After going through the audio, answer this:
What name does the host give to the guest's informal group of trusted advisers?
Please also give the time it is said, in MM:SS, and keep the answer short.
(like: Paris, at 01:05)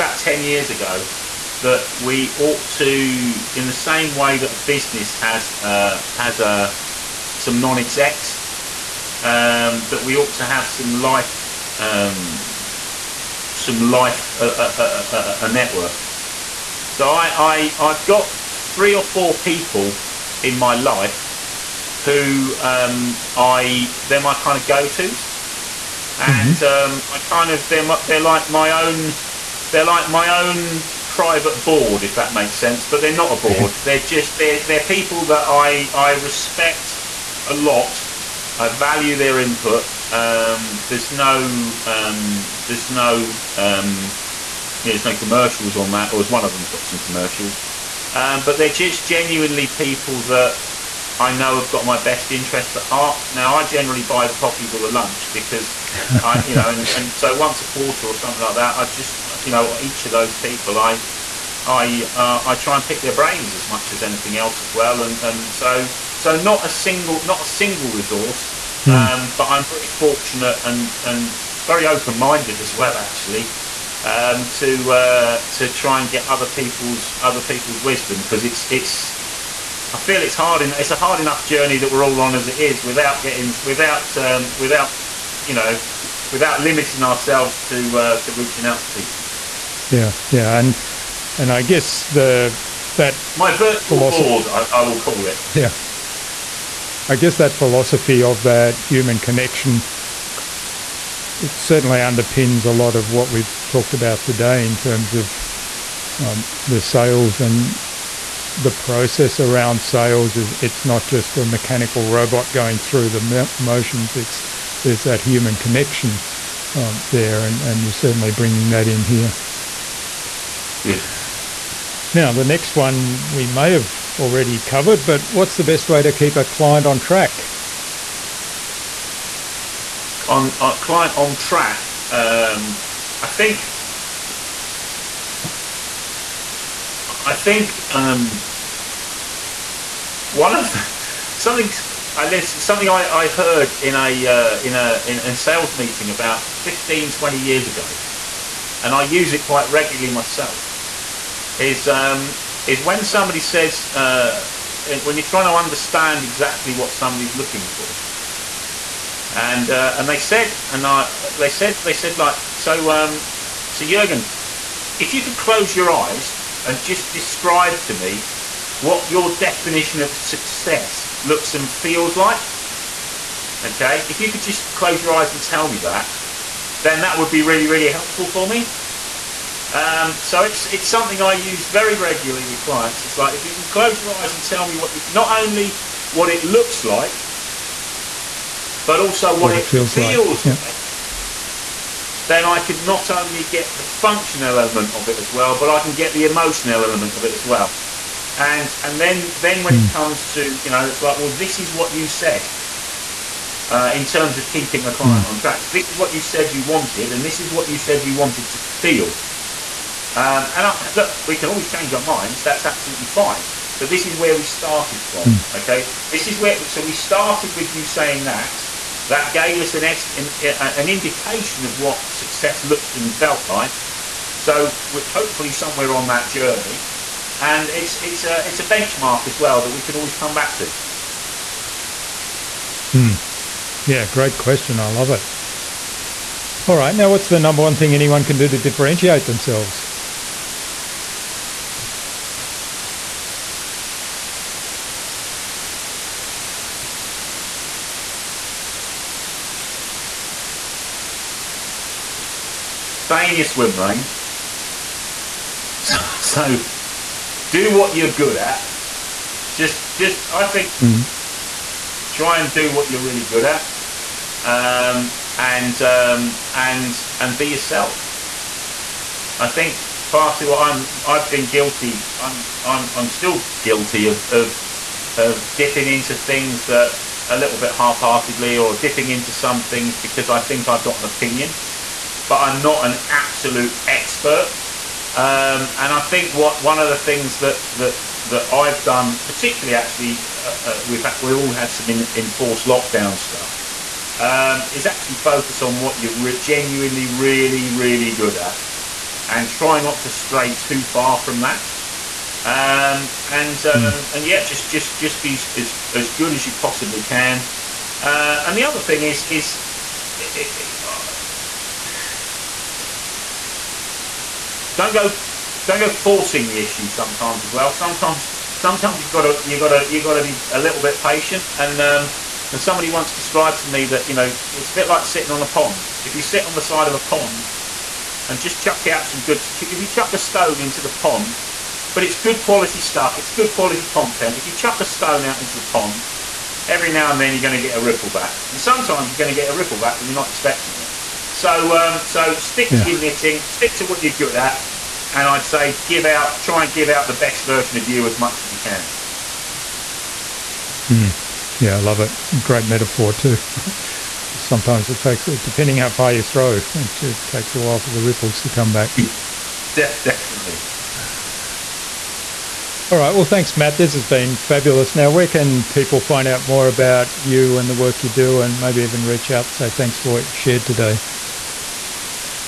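virtual philosophy board, at 01:33.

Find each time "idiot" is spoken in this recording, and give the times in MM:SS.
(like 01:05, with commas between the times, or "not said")
not said.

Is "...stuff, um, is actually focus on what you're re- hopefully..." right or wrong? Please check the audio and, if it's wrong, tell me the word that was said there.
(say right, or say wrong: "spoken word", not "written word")
wrong: "genuinely", not "hopefully".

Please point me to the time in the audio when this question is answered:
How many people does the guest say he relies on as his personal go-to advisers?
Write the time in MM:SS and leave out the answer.
00:18.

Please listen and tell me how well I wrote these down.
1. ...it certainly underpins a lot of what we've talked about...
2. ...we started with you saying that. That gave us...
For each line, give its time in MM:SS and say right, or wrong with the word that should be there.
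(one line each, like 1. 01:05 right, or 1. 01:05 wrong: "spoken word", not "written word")
1. 01:41 right
2. 03:36 right.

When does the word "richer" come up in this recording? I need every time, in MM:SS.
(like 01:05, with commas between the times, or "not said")
not said.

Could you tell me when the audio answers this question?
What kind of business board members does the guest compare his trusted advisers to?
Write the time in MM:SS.
00:07.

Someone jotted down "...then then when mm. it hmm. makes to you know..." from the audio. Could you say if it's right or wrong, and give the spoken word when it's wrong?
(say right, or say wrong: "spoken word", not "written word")
wrong: "comes", not "makes".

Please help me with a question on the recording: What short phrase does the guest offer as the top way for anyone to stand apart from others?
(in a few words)
Stay in your swim lane.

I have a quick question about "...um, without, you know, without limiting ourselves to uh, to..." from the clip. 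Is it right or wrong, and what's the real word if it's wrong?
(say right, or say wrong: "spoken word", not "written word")
right.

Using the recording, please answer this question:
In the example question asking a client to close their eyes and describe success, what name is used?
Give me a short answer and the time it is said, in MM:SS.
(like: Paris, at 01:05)
Jurgen, at 02:43.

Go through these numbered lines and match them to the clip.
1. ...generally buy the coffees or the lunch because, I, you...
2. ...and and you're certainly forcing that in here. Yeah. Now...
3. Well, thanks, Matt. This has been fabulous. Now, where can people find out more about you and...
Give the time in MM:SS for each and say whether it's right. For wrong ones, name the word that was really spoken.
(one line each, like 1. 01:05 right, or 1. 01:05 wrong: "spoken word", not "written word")
1. 00:53 right
2. 01:57 wrong: "bringing", not "forcing"
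3. 06:03 right.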